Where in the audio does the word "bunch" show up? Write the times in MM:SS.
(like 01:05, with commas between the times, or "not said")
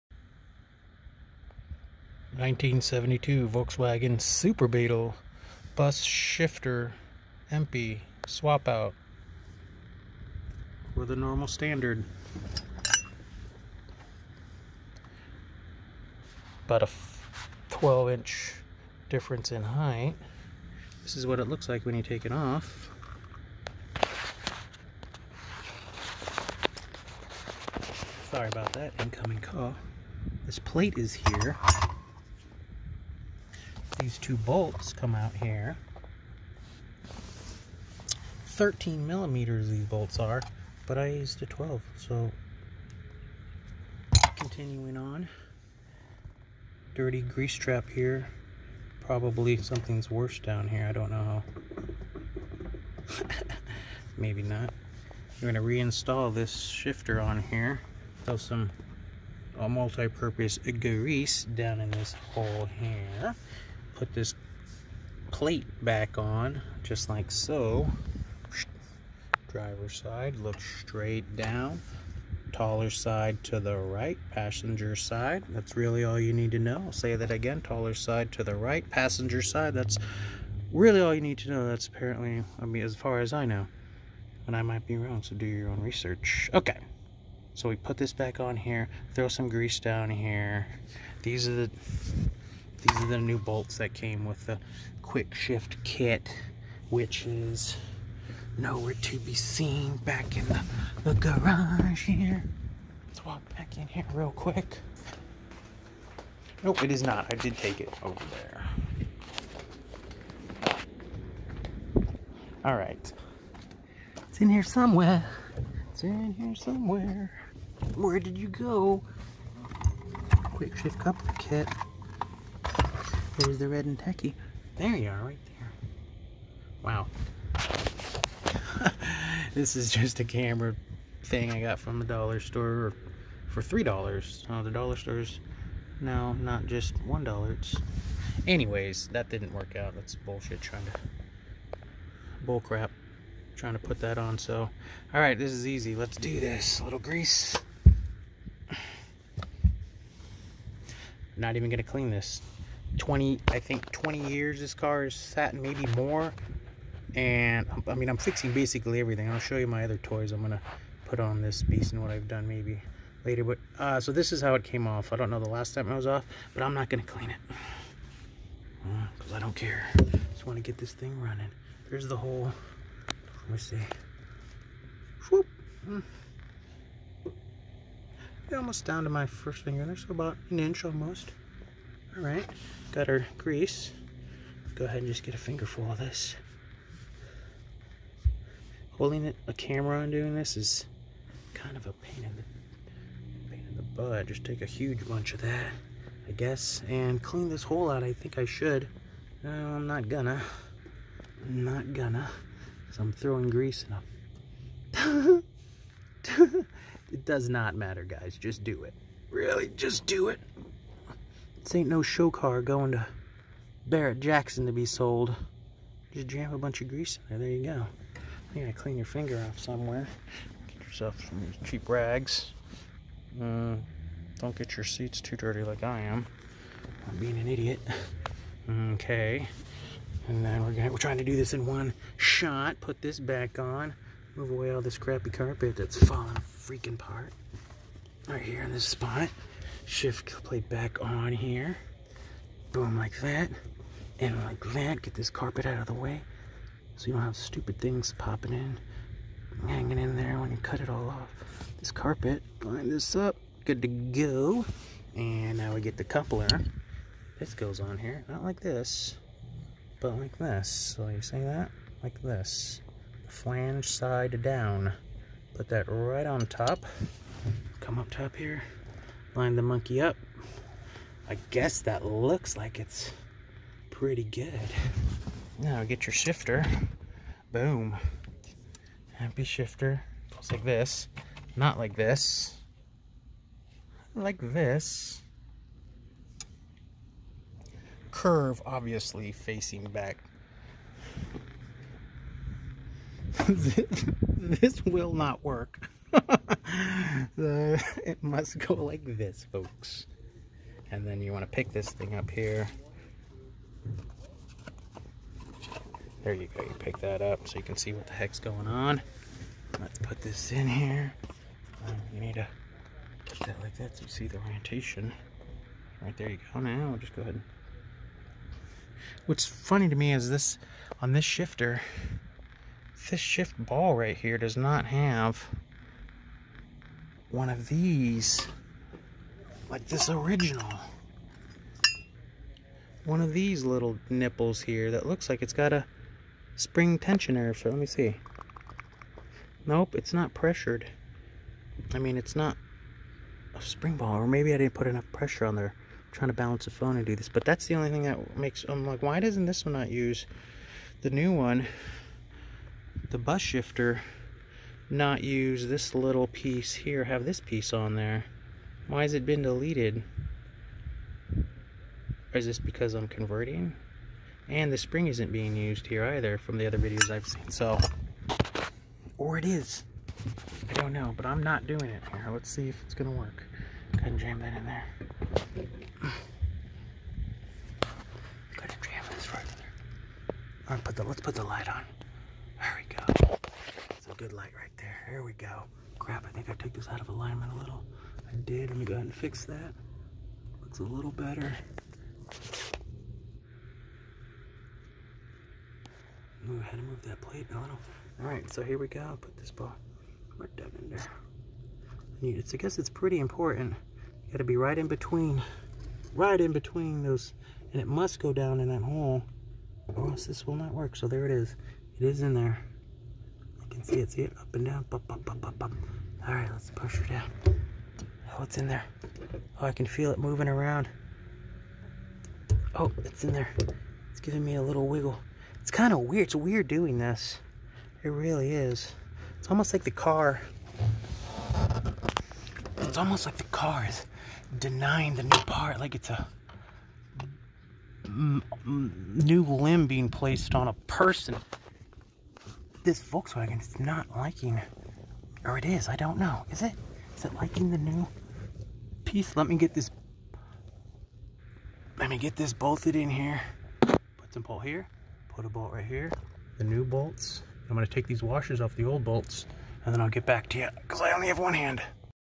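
03:15, 03:36.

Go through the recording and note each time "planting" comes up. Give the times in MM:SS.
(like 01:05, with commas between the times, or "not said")
not said.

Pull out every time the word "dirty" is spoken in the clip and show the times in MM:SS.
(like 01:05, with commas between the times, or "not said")
00:46, 03:45.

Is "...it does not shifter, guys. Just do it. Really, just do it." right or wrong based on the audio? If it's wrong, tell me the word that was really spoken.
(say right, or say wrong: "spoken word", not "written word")
wrong: "matter", not "shifter".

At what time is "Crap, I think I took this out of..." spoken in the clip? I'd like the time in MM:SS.
06:25.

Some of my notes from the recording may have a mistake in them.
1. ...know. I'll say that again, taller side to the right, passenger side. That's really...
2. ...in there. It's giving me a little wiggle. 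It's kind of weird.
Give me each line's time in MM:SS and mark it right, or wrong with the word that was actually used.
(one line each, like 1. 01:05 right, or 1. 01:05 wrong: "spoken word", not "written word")
1. 01:16 right
2. 07:03 right.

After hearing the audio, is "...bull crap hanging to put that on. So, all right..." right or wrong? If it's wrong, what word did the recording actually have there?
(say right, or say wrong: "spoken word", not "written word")
wrong: "trying", not "hanging".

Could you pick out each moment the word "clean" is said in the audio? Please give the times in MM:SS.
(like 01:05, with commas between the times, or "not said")
02:31, 02:47, 03:17, 03:38.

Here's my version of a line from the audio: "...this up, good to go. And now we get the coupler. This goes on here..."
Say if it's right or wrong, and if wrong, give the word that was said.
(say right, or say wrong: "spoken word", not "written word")
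right.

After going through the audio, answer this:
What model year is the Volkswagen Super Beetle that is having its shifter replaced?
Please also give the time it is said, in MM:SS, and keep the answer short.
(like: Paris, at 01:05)
1972, at 00:02.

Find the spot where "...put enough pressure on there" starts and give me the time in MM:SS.
05:44.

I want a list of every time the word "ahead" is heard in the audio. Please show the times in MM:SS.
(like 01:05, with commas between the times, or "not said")
03:04, 05:17, 06:13, 06:18, 06:28, 06:36.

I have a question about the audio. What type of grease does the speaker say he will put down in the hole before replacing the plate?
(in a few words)
multi-purpose grease.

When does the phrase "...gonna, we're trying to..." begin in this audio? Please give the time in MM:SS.
03:50.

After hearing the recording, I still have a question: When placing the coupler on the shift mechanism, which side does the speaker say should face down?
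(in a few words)
Flange side.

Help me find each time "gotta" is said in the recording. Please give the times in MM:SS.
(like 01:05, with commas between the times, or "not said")
03:38, 06:44.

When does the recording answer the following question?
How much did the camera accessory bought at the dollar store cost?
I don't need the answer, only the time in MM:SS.
02:13.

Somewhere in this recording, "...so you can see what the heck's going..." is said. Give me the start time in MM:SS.
05:07.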